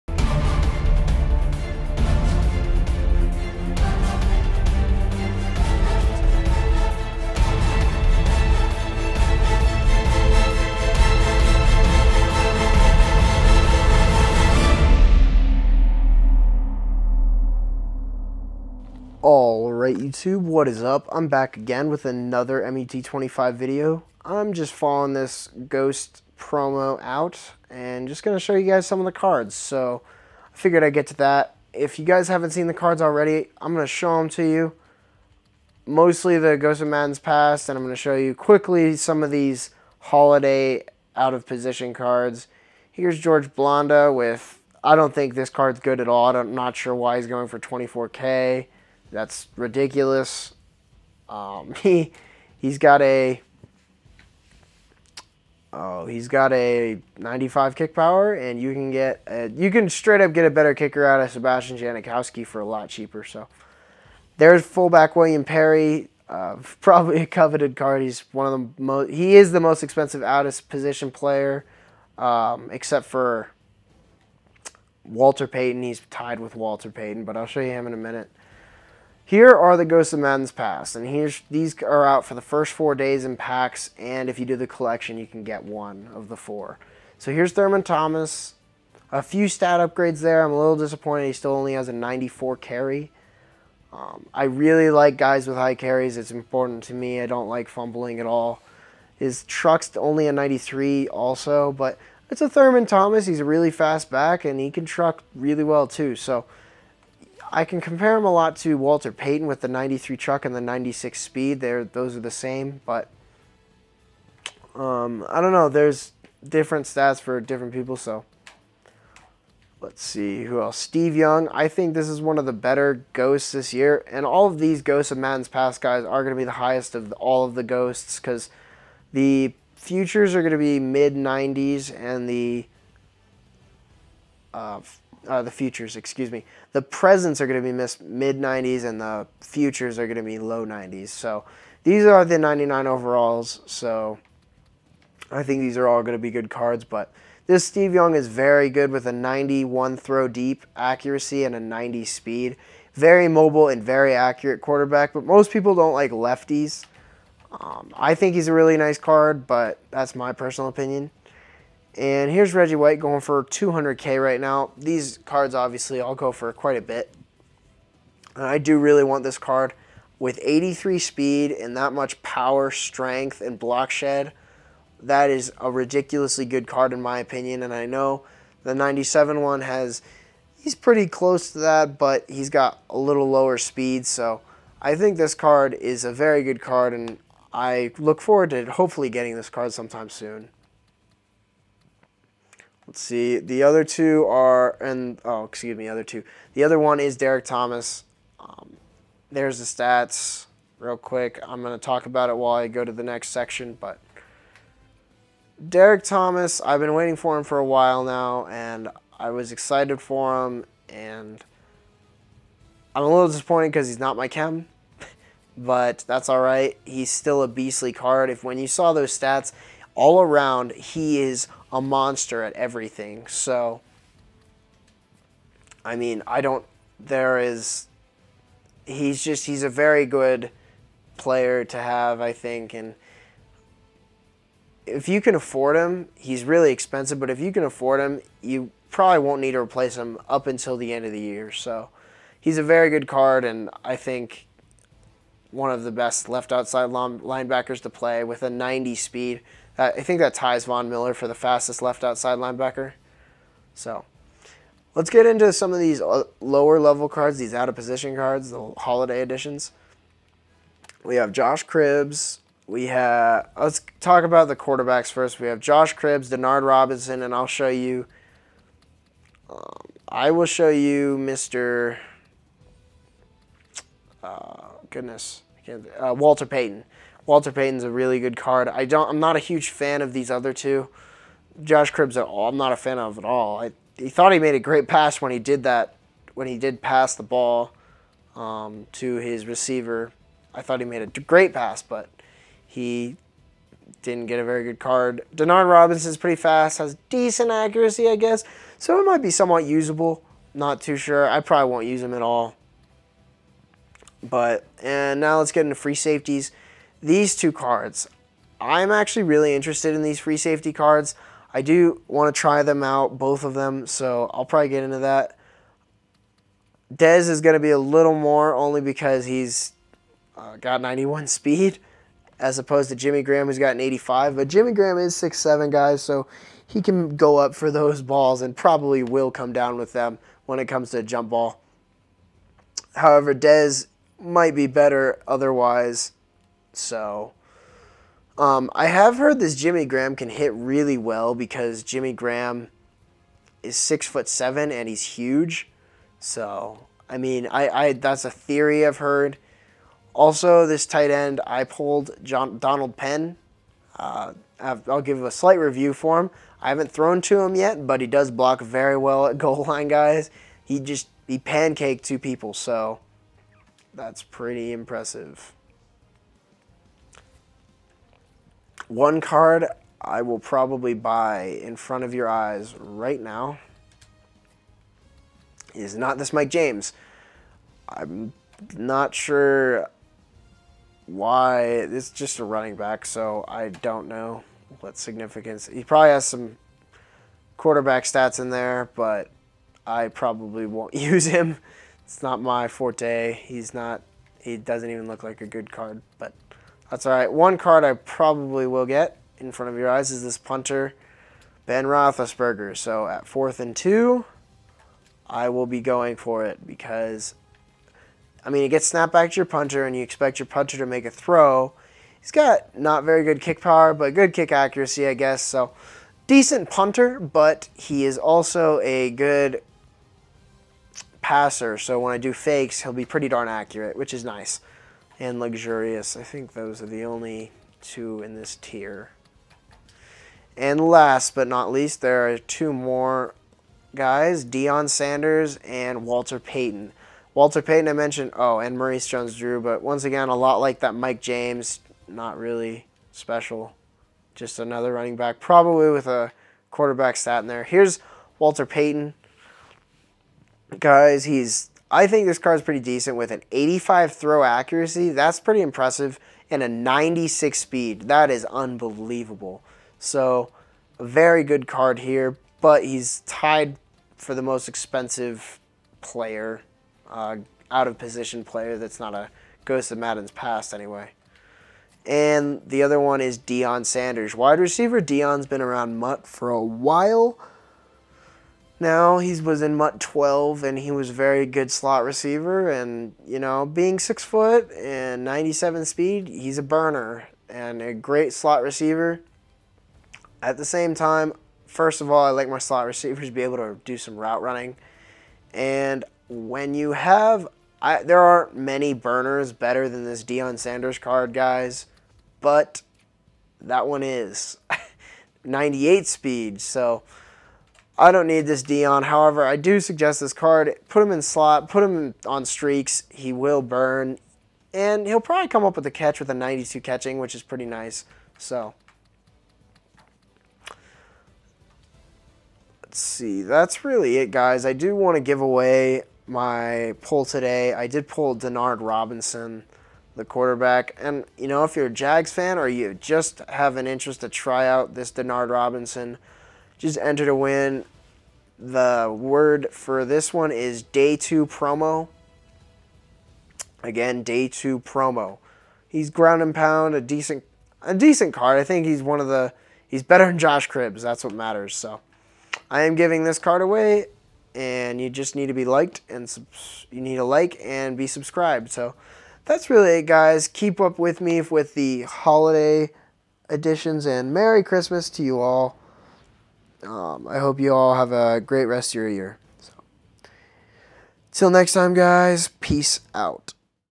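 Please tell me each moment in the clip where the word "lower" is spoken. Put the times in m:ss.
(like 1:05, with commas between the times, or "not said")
3:03, 4:16.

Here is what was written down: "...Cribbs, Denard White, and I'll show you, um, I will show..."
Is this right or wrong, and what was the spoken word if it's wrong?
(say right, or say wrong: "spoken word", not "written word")
wrong: "Robinson", not "White".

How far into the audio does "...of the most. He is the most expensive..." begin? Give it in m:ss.
1:08.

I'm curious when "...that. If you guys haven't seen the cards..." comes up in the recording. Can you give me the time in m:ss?
0:31.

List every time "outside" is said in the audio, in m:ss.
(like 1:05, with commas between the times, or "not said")
4:06, 4:12.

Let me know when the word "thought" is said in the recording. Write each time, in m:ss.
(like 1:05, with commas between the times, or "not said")
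4:44, 4:50.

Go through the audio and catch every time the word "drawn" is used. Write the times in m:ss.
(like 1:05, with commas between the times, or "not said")
not said.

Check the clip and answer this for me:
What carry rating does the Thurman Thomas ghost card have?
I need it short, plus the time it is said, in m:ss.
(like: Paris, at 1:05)
94, at 1:31.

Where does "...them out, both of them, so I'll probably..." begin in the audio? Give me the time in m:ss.
5:12.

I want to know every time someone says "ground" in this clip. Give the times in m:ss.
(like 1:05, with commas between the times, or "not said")
9:06.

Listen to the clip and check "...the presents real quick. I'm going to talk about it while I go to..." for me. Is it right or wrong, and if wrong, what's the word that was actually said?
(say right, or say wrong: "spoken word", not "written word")
wrong: "stats", not "presents".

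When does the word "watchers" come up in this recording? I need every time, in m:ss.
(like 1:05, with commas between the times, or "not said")
not said.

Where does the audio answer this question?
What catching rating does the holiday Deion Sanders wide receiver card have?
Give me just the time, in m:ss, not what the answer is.
8:36.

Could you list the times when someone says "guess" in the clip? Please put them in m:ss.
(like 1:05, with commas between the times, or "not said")
4:58, 6:55.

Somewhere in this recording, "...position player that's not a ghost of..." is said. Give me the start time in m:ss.
7:47.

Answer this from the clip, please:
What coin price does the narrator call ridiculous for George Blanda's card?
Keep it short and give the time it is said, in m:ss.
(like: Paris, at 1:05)
24K, at 0:47.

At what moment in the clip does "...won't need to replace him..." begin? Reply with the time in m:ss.
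3:59.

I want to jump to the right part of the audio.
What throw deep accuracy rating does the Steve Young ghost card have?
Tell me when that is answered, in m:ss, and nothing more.
2:29.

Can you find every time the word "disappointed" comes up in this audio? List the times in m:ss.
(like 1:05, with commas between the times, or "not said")
1:30, 3:33.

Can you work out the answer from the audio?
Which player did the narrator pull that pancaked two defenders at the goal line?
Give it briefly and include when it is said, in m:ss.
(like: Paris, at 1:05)
Donald Penn, at 5:52.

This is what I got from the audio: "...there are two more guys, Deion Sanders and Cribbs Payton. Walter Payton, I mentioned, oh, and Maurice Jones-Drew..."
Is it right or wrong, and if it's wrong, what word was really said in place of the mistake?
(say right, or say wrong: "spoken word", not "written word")
wrong: "Walter", not "Cribbs".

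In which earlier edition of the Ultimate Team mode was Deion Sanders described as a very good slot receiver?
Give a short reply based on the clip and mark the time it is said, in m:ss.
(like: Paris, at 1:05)
MUT 12, at 7:59.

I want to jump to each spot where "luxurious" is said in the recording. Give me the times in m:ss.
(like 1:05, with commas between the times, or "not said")
7:05.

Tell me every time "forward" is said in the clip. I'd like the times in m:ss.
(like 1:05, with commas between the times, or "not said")
3:08.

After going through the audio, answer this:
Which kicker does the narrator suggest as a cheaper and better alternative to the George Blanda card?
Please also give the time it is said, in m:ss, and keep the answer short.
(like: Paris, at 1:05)
Sebastian Janikowski, at 1:01.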